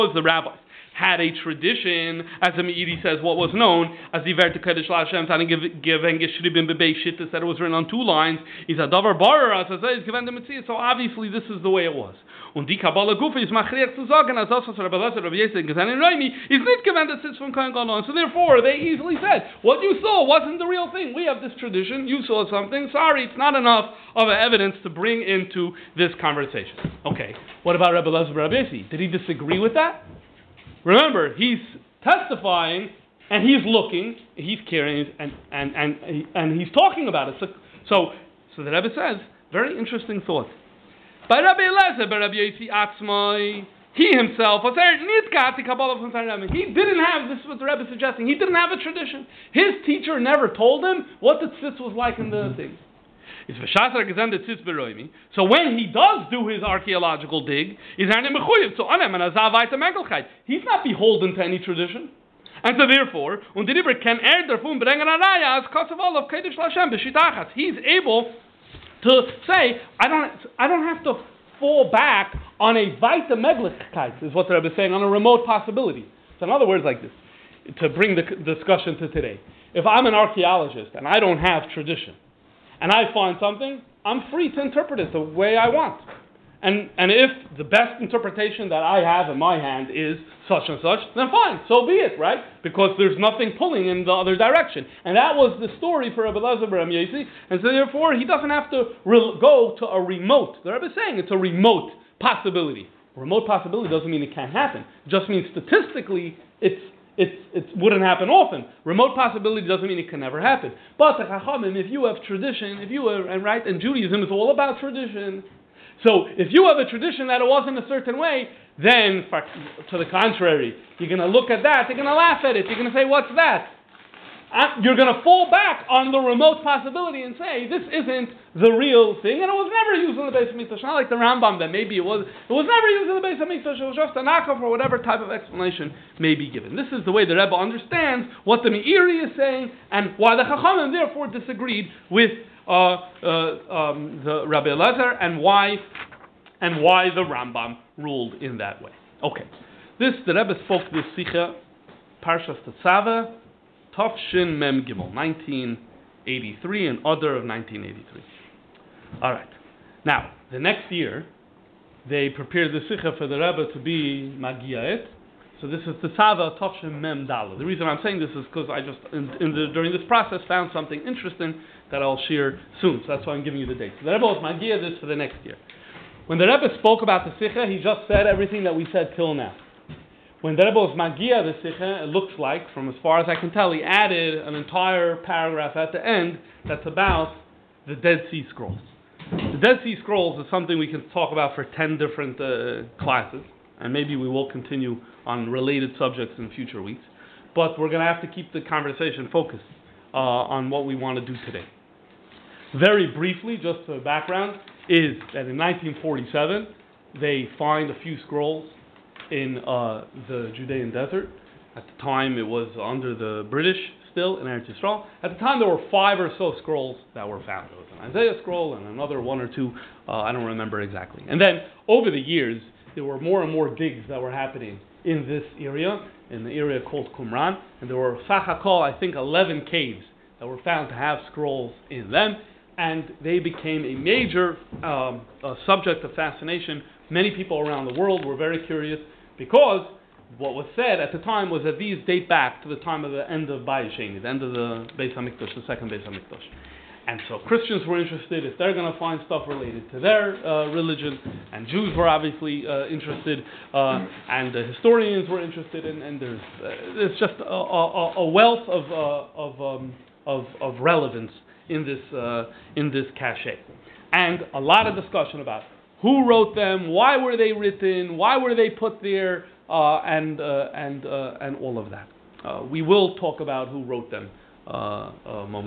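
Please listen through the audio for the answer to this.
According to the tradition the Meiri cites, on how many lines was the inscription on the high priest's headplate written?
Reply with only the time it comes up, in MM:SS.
00:07.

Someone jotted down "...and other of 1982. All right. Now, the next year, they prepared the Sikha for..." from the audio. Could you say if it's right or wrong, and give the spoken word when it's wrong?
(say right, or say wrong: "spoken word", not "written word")
wrong: "1983", not "1982".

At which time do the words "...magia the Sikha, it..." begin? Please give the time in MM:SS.
03:00.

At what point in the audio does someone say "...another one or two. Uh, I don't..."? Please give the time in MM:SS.
03:38.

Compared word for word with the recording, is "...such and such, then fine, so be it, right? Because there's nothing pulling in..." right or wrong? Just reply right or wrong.
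right.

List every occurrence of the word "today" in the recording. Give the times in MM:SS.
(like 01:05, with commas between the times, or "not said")
01:19, 03:21.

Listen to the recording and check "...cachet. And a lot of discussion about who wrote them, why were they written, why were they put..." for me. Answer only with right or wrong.
right.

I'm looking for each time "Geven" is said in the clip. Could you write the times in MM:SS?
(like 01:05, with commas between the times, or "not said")
00:05, 00:10.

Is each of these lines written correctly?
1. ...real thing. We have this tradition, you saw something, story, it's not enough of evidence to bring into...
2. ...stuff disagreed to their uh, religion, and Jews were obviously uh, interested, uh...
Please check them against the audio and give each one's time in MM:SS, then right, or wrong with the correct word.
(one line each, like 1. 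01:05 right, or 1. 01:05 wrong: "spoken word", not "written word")
1. 00:20 wrong: "sorry", not "story"
2. 04:09 wrong: "related", not "disagreed".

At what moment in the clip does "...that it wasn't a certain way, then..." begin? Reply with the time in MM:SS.
01:57.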